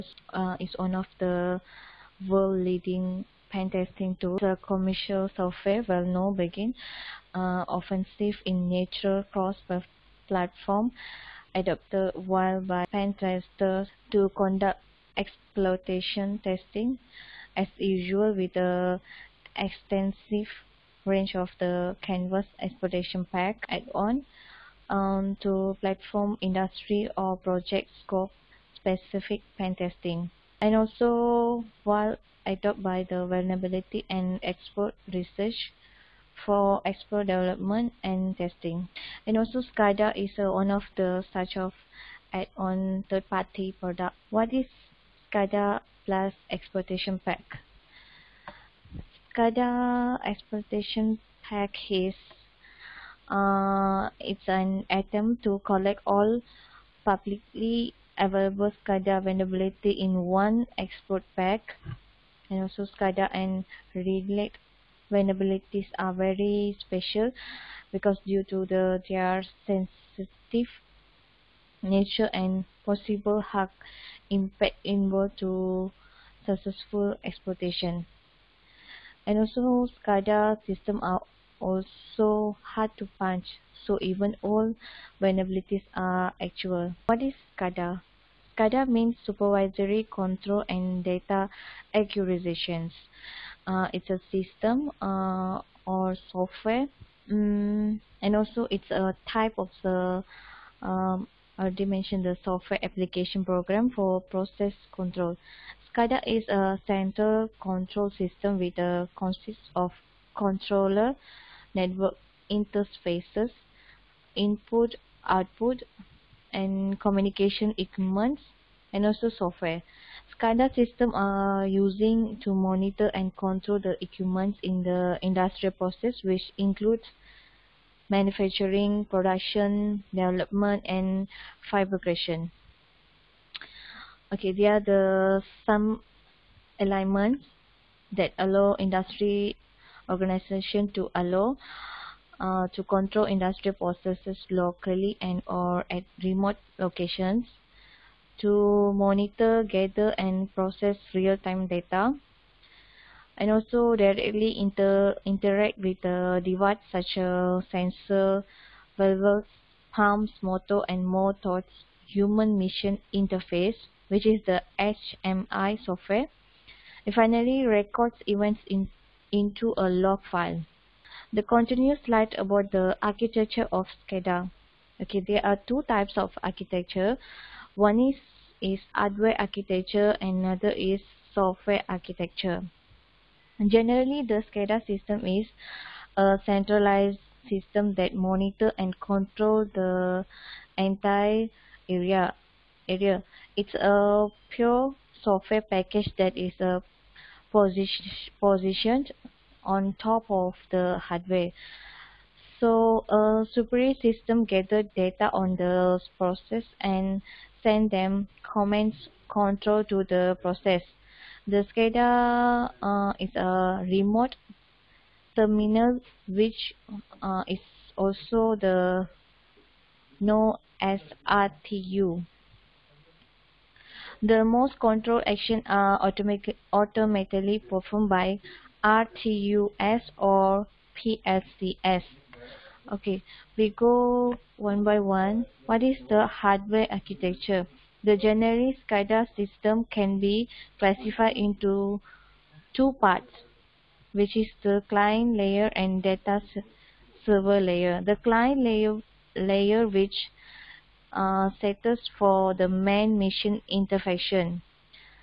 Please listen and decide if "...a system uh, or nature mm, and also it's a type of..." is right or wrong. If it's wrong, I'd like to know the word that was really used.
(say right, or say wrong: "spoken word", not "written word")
wrong: "software", not "nature".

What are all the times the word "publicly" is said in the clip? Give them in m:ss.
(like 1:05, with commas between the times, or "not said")
0:57.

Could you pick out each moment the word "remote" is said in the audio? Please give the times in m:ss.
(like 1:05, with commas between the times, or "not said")
2:26, 3:33.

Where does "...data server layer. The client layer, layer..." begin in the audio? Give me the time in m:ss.
4:06.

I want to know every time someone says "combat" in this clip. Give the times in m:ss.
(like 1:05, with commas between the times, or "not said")
not said.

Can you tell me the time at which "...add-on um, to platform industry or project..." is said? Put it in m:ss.
0:23.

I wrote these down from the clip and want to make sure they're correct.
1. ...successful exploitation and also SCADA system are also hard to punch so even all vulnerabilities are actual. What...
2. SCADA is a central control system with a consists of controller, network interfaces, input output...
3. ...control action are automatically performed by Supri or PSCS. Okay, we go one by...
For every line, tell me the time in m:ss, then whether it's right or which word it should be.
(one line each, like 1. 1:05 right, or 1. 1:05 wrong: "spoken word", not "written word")
1. 1:16 right
2. 1:45 right
3. 3:44 wrong: "RTUS", not "Supri".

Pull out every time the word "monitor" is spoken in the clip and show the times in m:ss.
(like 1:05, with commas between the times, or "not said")
2:02, 2:28, 3:08.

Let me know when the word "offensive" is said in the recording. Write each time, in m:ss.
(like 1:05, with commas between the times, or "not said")
0:07.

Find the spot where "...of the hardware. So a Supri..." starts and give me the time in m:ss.
3:20.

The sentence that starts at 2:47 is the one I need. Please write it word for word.
And finally, records events in, into a log file the continuous slide about the architecture of SCADA.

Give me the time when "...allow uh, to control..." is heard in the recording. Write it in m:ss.
2:21.